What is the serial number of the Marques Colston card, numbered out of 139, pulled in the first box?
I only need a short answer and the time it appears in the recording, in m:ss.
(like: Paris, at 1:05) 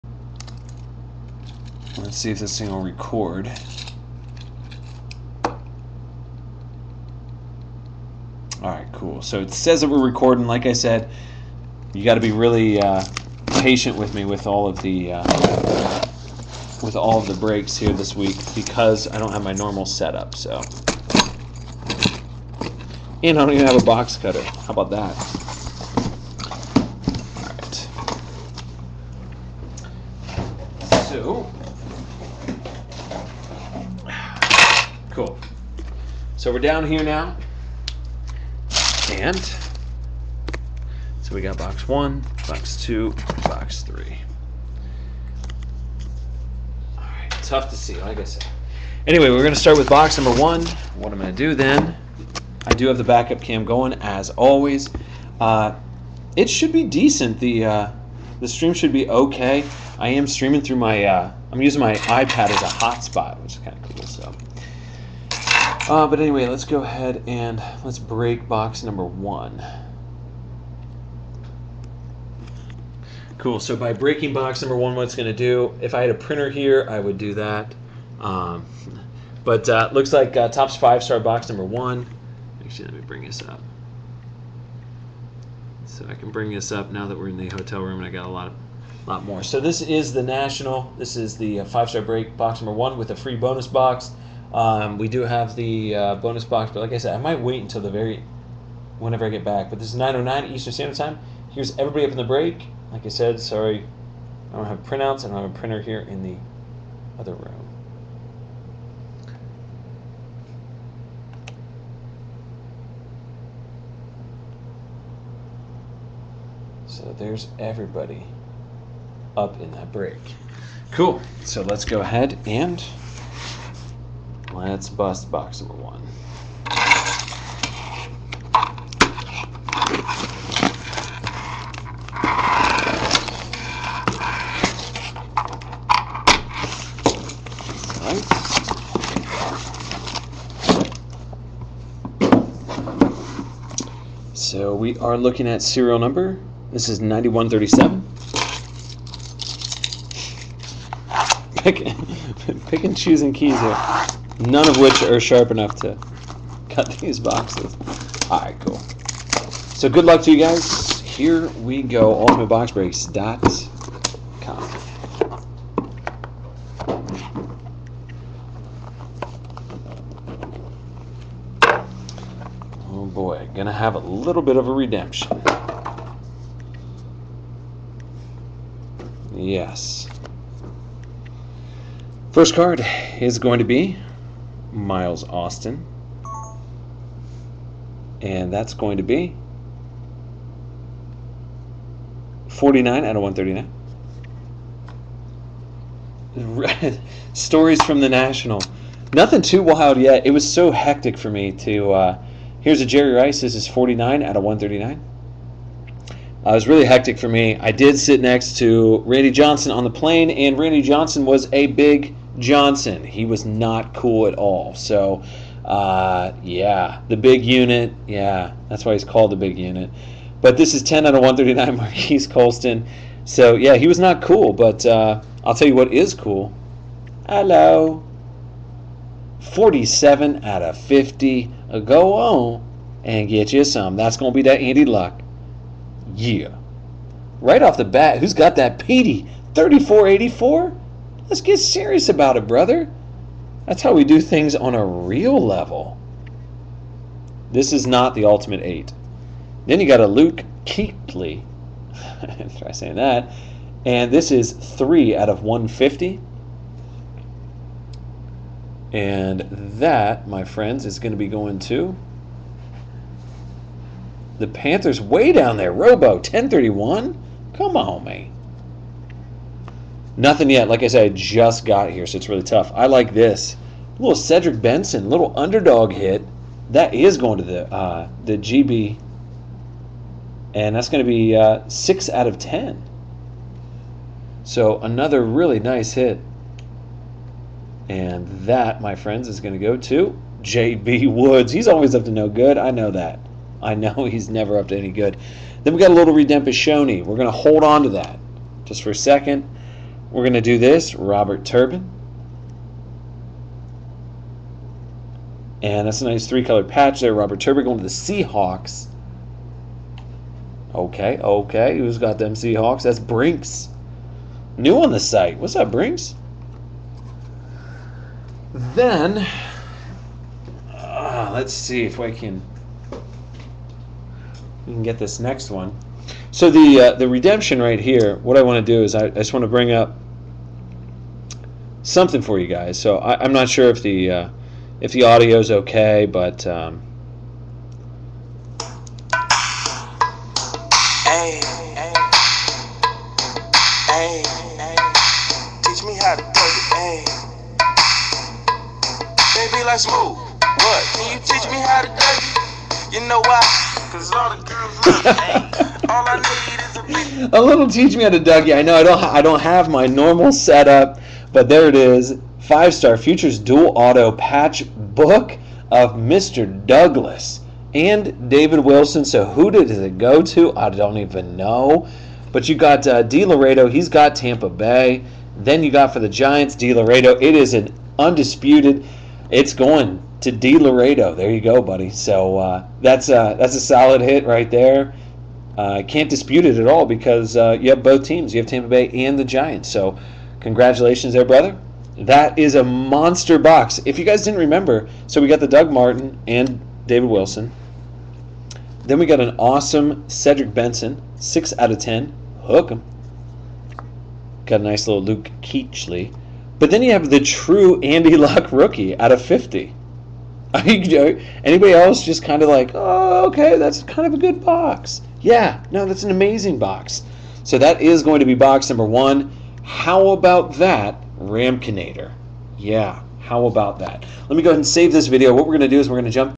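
10, at 3:40.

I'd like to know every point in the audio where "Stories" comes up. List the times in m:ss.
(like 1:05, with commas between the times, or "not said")
3:17.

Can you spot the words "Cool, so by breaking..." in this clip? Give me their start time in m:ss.
1:13.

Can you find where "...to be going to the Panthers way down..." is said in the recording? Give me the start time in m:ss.
4:21.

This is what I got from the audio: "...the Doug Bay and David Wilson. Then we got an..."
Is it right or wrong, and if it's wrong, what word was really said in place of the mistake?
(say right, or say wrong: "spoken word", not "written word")
wrong: "Martin", not "Bay".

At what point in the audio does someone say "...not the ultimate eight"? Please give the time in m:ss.
4:07.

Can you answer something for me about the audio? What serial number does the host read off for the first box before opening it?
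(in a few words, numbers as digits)
9137.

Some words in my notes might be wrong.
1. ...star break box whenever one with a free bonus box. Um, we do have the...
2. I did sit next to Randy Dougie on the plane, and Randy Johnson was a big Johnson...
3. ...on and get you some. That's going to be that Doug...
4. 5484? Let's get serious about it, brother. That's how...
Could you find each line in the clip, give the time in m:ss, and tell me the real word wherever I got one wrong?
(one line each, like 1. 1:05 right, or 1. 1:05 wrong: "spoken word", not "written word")
1. 1:31 wrong: "number", not "whenever"
2. 3:27 wrong: "Johnson", not "Dougie"
3. 3:52 wrong: "Andy", not "Doug"
4. 3:59 wrong: "3484", not "5484".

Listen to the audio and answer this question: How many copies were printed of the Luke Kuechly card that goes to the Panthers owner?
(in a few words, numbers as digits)
150.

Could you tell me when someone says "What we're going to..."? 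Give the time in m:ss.
7:05.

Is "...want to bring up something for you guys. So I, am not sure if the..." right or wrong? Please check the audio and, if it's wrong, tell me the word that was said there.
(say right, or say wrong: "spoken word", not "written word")
right.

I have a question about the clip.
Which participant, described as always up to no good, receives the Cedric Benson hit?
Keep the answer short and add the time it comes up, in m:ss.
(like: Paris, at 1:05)
JB Woods, at 4:50.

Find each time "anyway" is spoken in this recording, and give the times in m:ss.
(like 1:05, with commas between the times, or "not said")
0:49, 1:06.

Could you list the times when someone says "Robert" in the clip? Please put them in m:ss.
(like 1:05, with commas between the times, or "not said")
5:00, 5:07.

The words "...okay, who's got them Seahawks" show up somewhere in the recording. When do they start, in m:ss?
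5:11.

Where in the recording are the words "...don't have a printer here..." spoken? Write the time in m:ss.
1:45.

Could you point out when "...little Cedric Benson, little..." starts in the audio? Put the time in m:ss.
4:34.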